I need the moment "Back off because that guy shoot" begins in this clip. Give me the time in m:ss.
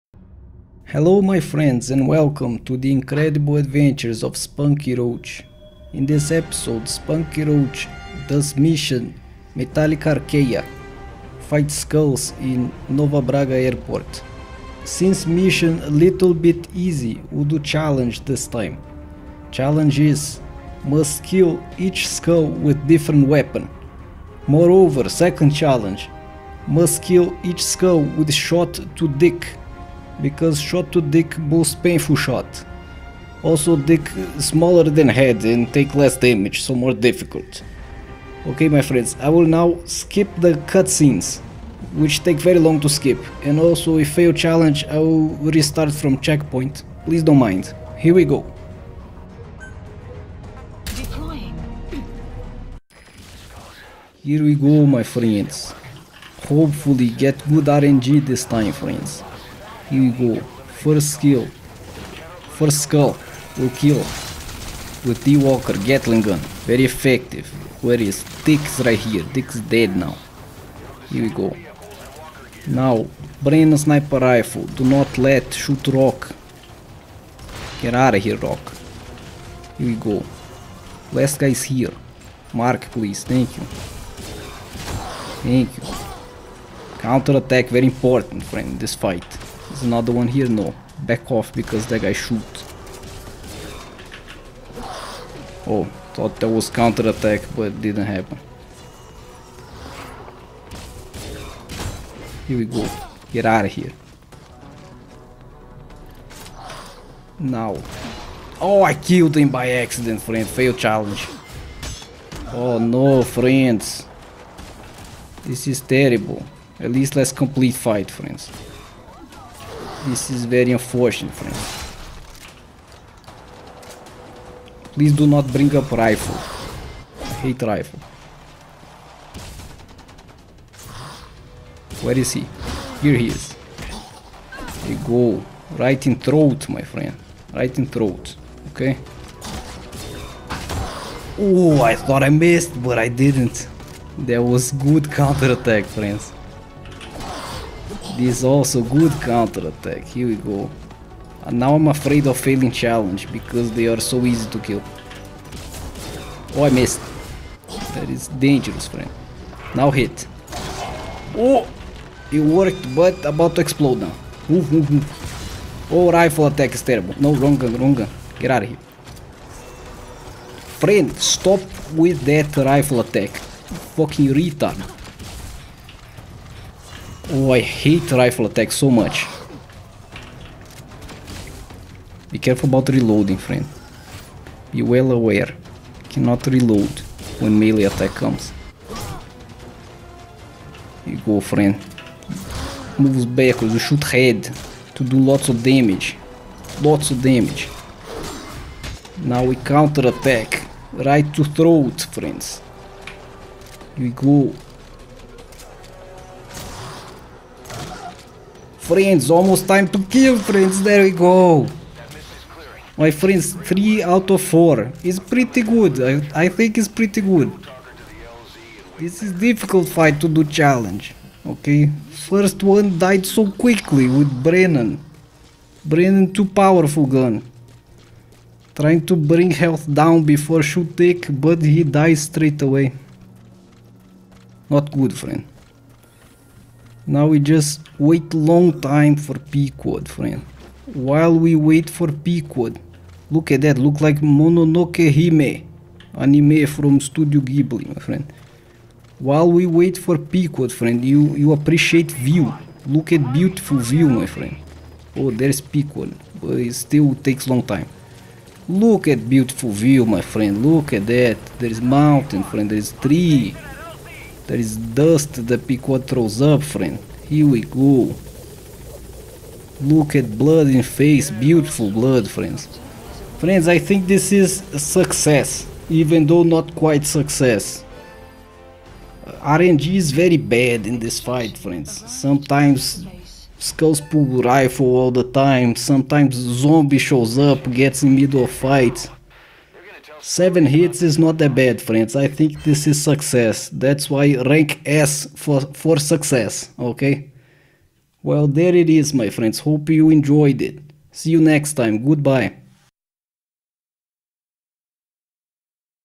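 1:30.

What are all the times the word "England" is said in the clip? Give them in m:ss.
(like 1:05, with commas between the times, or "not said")
not said.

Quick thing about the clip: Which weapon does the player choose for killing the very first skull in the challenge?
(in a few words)
Walker Gatling gun.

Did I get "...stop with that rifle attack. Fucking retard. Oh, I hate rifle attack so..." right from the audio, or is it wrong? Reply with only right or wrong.
right.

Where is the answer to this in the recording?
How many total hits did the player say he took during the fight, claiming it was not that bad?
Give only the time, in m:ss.
4:50.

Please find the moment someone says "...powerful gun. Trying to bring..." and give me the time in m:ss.
3:46.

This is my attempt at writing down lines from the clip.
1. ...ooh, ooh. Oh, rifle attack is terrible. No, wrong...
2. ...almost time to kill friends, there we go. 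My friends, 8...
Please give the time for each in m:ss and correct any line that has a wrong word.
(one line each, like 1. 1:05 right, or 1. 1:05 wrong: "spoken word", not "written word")
1. 2:44 right
2. 3:29 wrong: "3", not "8".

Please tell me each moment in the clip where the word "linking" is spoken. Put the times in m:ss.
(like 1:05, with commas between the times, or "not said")
not said.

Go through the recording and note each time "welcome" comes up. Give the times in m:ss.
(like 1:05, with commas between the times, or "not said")
0:02.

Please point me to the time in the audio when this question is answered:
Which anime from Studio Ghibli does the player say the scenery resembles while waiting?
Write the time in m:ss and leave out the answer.
4:04.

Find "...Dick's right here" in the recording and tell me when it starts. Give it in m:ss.
1:08.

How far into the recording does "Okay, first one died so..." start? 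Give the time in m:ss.
3:41.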